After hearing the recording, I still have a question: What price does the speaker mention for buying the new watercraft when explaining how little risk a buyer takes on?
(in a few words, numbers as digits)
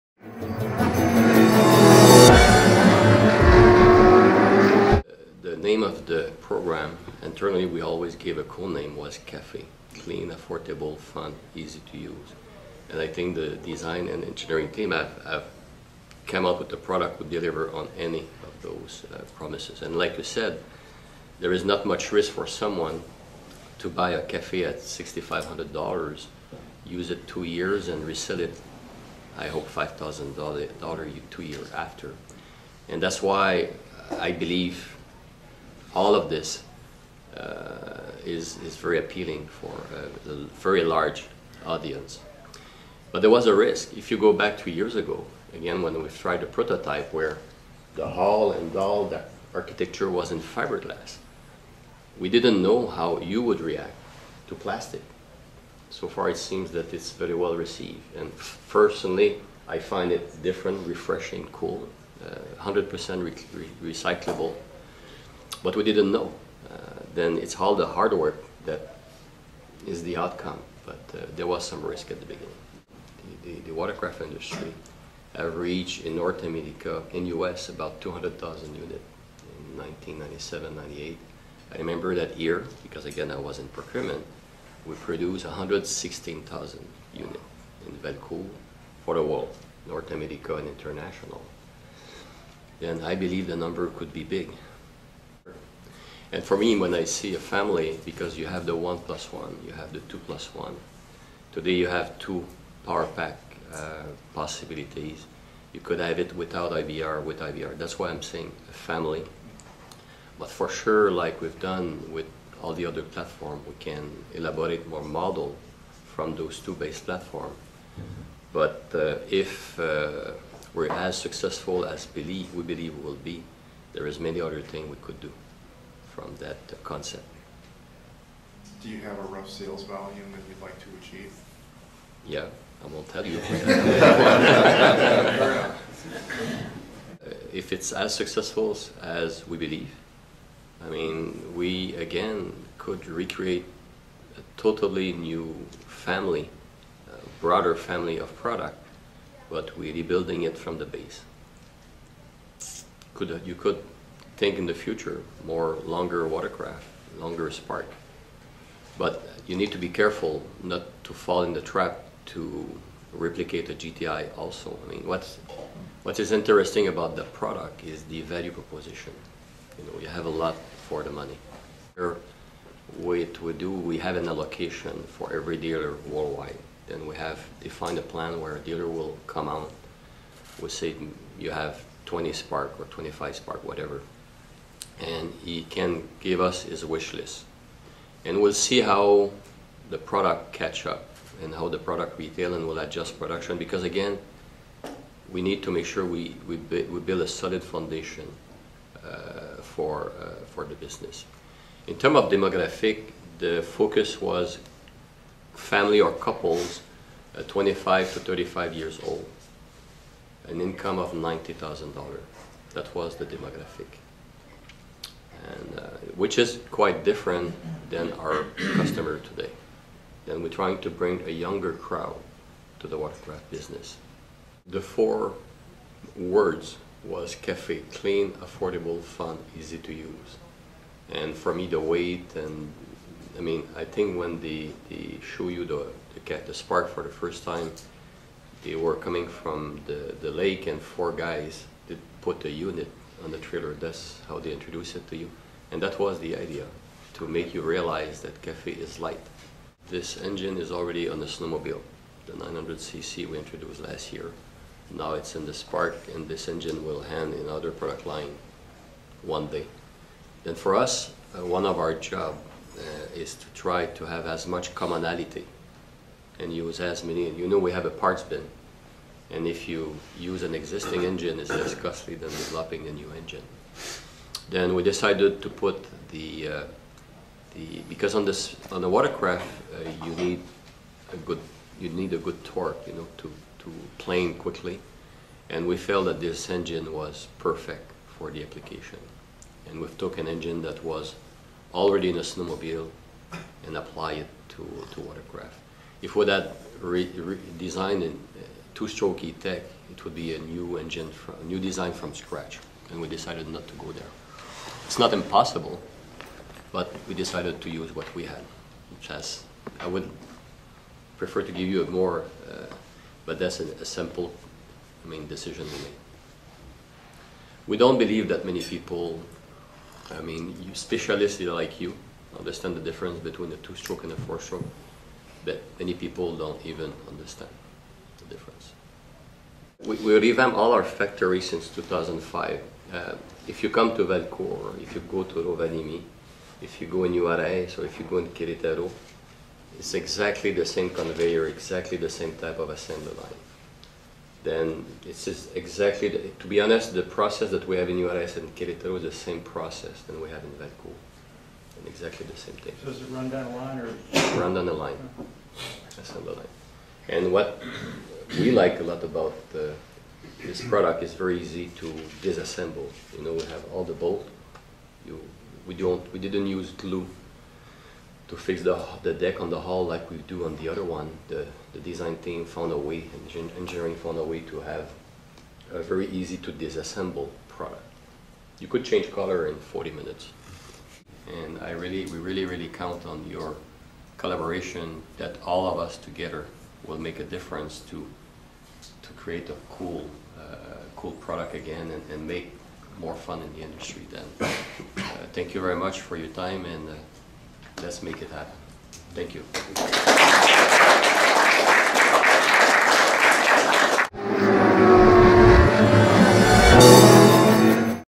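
$6,500.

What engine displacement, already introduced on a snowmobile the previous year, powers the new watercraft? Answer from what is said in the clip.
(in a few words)
900cc.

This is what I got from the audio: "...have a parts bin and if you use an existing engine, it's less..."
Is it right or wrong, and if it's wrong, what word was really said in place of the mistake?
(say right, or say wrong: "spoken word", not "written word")
right.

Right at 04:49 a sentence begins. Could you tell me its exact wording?
And we took an engine that was already in a snowmobile and apply it to, to watercraft.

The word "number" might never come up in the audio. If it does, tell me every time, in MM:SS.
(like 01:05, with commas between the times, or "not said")
01:33.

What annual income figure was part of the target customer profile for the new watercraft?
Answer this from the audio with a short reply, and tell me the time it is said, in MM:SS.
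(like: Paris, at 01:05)
$90,000, at 03:31.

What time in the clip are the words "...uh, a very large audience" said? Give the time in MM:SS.
00:40.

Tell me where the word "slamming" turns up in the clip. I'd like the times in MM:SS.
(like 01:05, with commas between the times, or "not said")
not said.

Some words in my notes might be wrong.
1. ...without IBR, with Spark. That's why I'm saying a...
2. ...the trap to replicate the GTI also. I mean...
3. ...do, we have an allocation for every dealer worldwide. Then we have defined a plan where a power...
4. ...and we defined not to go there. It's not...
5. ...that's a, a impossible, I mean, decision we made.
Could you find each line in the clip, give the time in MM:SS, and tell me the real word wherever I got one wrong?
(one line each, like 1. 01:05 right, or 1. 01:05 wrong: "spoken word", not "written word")
1. 01:46 wrong: "IBR", not "Spark"
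2. 02:41 right
3. 02:53 wrong: "dealer", not "power"
4. 05:02 wrong: "decided", not "defined"
5. 05:13 wrong: "simple", not "impossible".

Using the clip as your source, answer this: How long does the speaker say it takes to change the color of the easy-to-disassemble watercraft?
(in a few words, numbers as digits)
40 minutes.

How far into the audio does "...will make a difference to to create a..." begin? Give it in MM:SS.
06:26.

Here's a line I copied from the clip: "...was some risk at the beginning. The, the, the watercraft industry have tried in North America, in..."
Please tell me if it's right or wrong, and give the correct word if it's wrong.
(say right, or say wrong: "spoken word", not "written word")
wrong: "reached", not "tried".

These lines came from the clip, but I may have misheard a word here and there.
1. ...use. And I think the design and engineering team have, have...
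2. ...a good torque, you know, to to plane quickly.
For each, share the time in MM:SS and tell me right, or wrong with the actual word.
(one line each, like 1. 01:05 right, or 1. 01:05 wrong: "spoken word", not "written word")
1. 00:11 right
2. 04:42 right.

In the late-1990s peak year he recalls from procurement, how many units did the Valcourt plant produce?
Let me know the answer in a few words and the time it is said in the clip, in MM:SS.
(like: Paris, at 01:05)
116,000, at 01:25.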